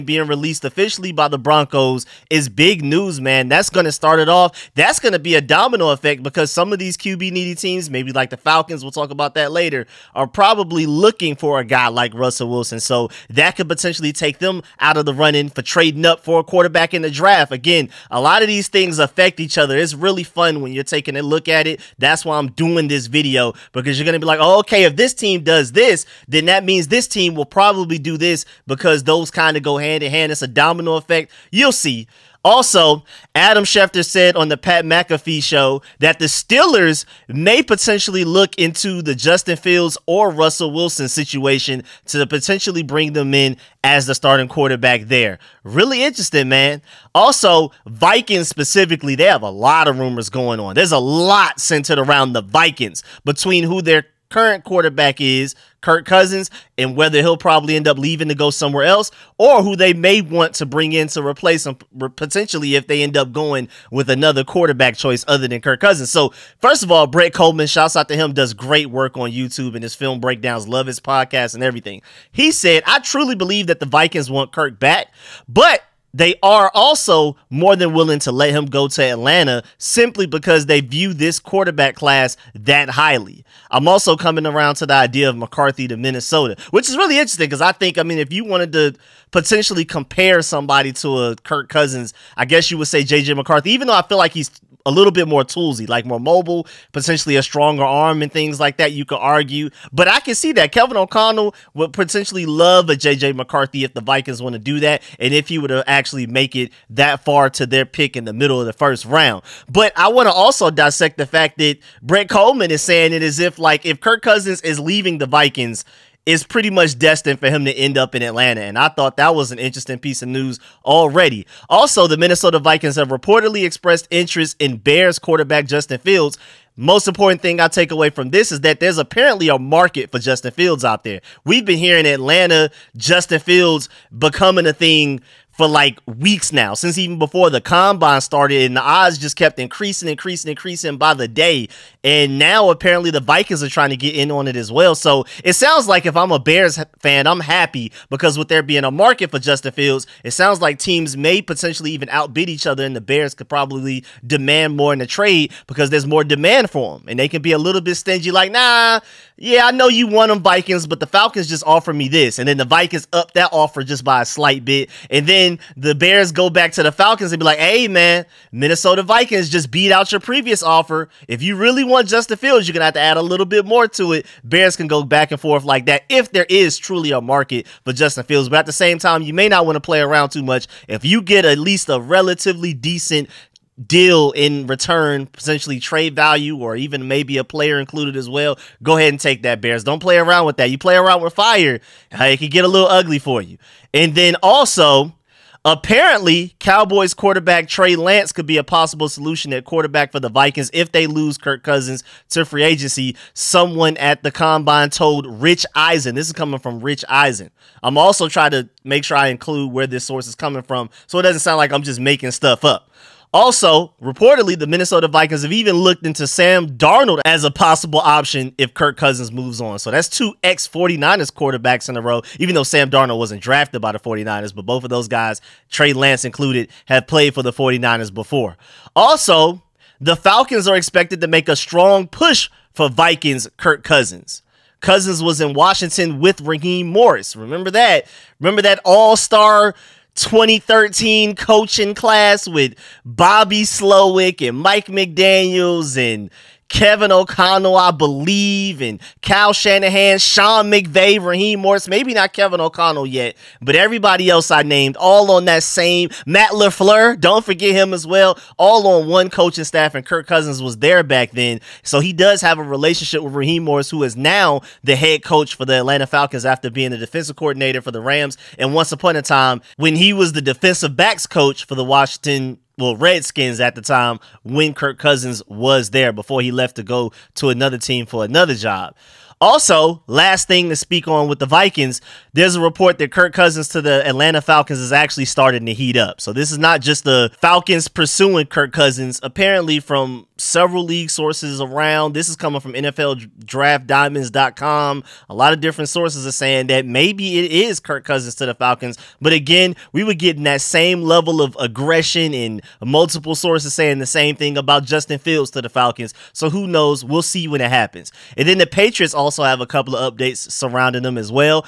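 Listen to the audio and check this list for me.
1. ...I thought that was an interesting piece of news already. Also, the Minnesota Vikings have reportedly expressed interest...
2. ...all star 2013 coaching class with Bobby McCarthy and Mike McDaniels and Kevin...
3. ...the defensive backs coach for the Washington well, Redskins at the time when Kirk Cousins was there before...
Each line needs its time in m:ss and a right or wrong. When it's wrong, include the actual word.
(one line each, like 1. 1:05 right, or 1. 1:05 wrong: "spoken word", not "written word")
1. 1:58 right
2. 3:58 wrong: "Slowik", not "McCarthy"
3. 4:30 right.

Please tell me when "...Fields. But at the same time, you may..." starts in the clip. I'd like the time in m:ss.
2:58.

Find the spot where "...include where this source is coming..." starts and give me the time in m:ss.
3:29.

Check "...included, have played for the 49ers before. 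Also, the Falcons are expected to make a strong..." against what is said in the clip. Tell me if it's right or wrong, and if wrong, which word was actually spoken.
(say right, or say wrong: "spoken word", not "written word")
right.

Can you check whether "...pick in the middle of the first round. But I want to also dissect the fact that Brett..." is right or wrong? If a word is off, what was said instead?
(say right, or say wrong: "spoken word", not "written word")
right.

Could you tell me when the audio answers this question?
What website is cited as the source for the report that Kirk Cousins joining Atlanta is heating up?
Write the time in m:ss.
4:52.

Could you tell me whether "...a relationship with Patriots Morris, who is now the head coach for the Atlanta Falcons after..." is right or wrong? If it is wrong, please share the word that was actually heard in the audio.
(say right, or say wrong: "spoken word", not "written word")
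wrong: "Raheem", not "Patriots".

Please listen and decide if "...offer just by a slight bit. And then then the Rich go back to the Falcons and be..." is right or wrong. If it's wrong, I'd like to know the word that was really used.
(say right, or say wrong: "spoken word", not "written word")
wrong: "Bears", not "Rich".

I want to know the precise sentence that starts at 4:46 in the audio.
So this is not just the Falcons pursuing Kirk Cousins.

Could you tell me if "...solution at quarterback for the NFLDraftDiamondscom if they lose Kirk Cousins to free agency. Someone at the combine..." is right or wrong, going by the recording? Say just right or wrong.
wrong.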